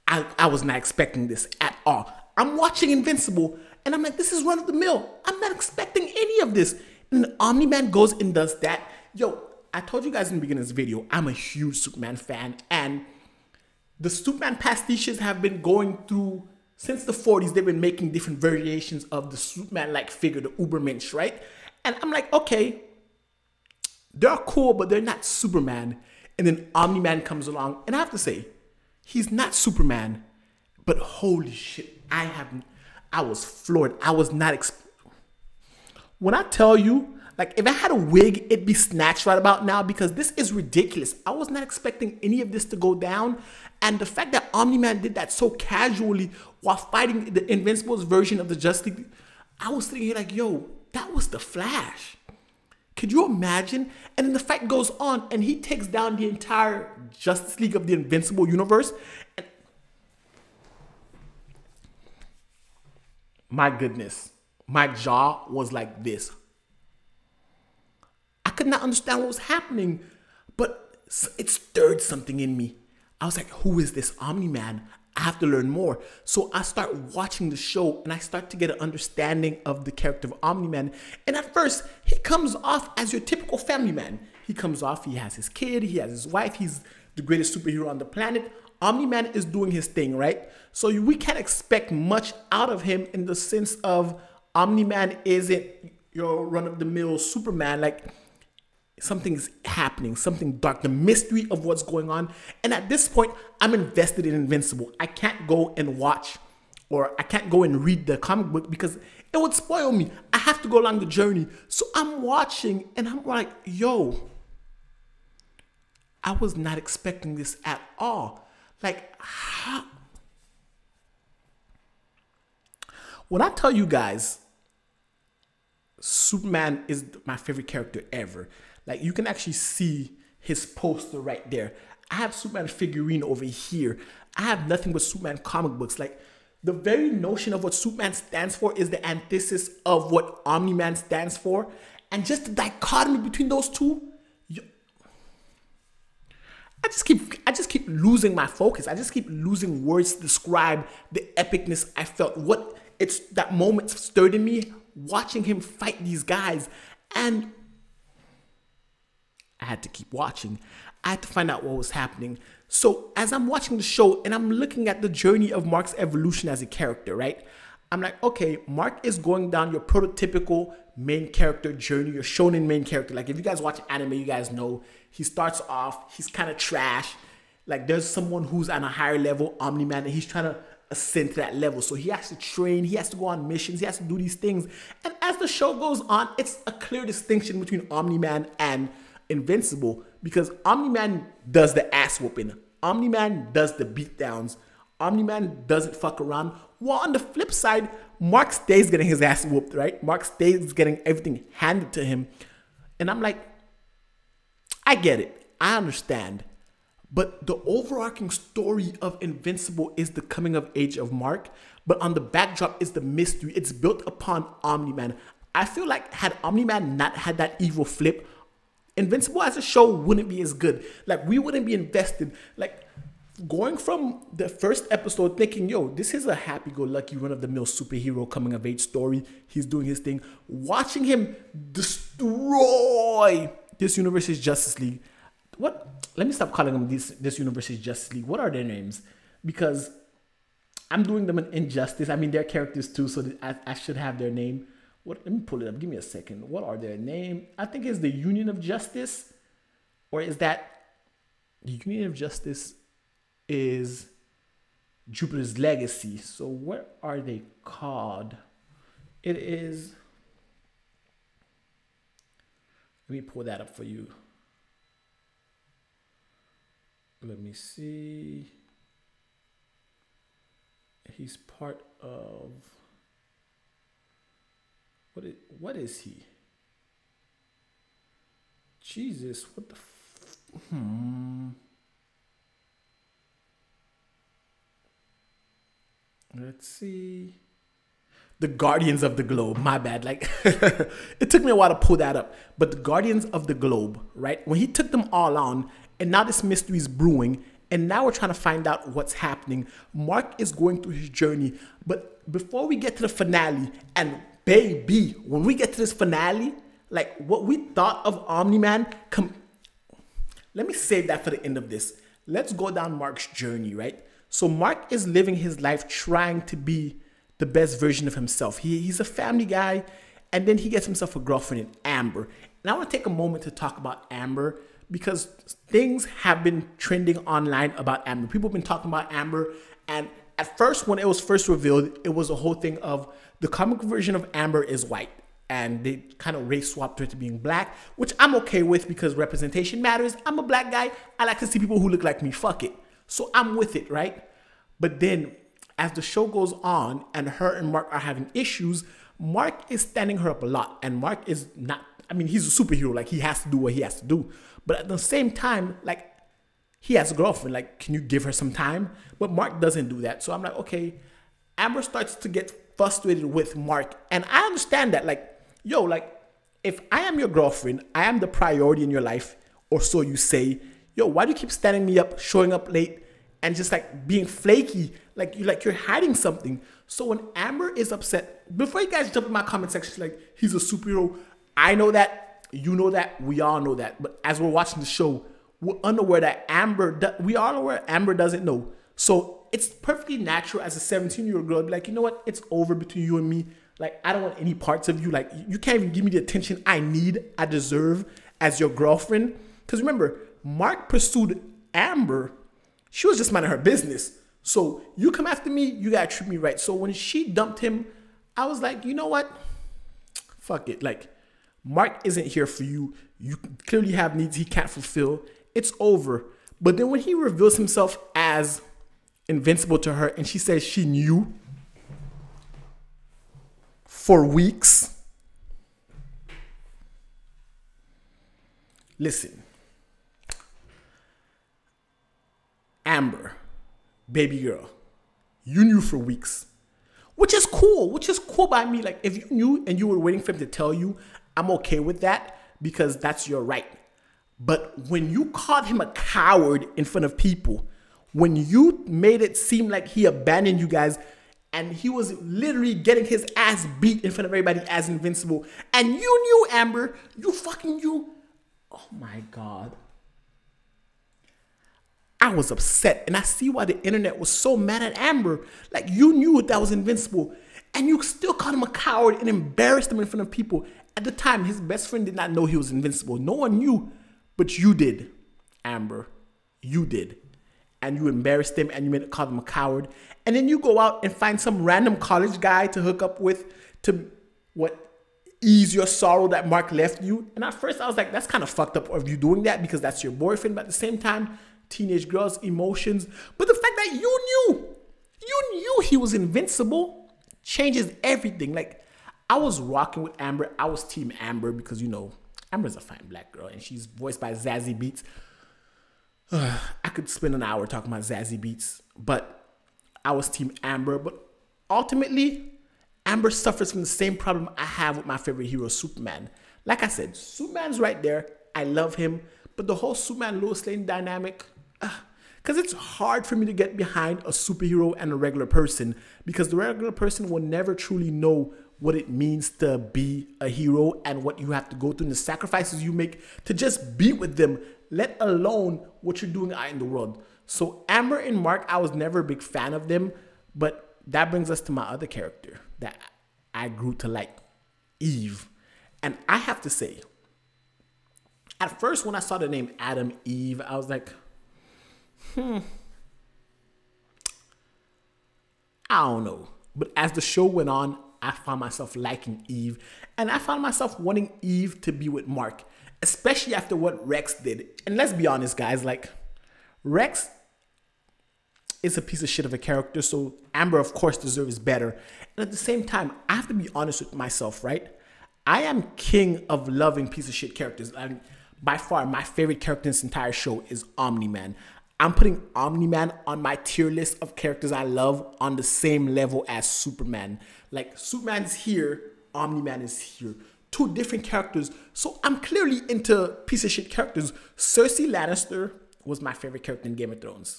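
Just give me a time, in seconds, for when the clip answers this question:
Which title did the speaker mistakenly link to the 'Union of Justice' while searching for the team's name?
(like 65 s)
255 s.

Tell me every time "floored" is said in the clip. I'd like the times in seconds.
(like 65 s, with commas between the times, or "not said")
33 s.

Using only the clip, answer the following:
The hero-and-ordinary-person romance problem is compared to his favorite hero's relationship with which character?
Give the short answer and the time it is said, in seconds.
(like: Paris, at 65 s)
Lois Lane, at 520 s.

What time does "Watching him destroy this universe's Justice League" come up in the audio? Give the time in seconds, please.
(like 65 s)
230 s.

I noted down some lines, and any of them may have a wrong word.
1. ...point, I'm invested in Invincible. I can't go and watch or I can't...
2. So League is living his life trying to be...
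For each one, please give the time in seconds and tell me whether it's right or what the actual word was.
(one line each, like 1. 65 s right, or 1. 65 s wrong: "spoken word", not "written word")
1. 103 s right
2. 314 s wrong: "Mark", not "League".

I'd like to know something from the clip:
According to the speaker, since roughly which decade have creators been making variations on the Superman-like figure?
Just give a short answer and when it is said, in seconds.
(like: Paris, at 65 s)
1940s, at 17 s.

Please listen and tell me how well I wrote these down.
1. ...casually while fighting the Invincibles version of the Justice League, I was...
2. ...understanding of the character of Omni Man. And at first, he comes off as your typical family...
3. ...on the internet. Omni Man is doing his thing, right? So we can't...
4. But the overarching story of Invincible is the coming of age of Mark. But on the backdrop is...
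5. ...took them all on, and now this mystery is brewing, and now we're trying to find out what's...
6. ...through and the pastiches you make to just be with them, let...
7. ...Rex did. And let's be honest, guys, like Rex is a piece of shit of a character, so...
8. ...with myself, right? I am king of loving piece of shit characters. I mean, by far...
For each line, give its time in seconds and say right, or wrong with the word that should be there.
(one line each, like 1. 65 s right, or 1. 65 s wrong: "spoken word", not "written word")
1. 45 s right
2. 78 s right
3. 87 s wrong: "planet", not "internet"
4. 207 s right
5. 294 s right
6. 531 s wrong: "sacrifices", not "pastiches"
7. 564 s right
8. 574 s right.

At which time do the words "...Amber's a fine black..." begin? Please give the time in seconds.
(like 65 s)
502 s.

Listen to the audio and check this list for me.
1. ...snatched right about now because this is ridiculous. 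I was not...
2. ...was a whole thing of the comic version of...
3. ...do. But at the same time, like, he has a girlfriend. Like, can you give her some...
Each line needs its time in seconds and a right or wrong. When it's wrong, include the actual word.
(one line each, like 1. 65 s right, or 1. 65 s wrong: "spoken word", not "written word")
1. 38 s right
2. 332 s right
3. 354 s right.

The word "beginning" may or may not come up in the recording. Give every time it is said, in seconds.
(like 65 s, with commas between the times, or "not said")
10 s.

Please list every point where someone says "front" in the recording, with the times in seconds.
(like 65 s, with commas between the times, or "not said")
446 s, 454 s, 470 s.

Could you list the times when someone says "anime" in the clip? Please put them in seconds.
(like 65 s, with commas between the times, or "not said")
173 s.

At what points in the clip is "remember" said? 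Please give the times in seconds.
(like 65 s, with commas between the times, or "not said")
399 s.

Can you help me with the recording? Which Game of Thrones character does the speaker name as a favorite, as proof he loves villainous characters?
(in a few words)
Cersei Lannister.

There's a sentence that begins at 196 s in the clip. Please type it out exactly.
While on the flip side, Mark stays getting his ass whooped, right?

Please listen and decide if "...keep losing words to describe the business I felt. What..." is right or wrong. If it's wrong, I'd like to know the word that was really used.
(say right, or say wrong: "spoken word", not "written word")
wrong: "epicness", not "business".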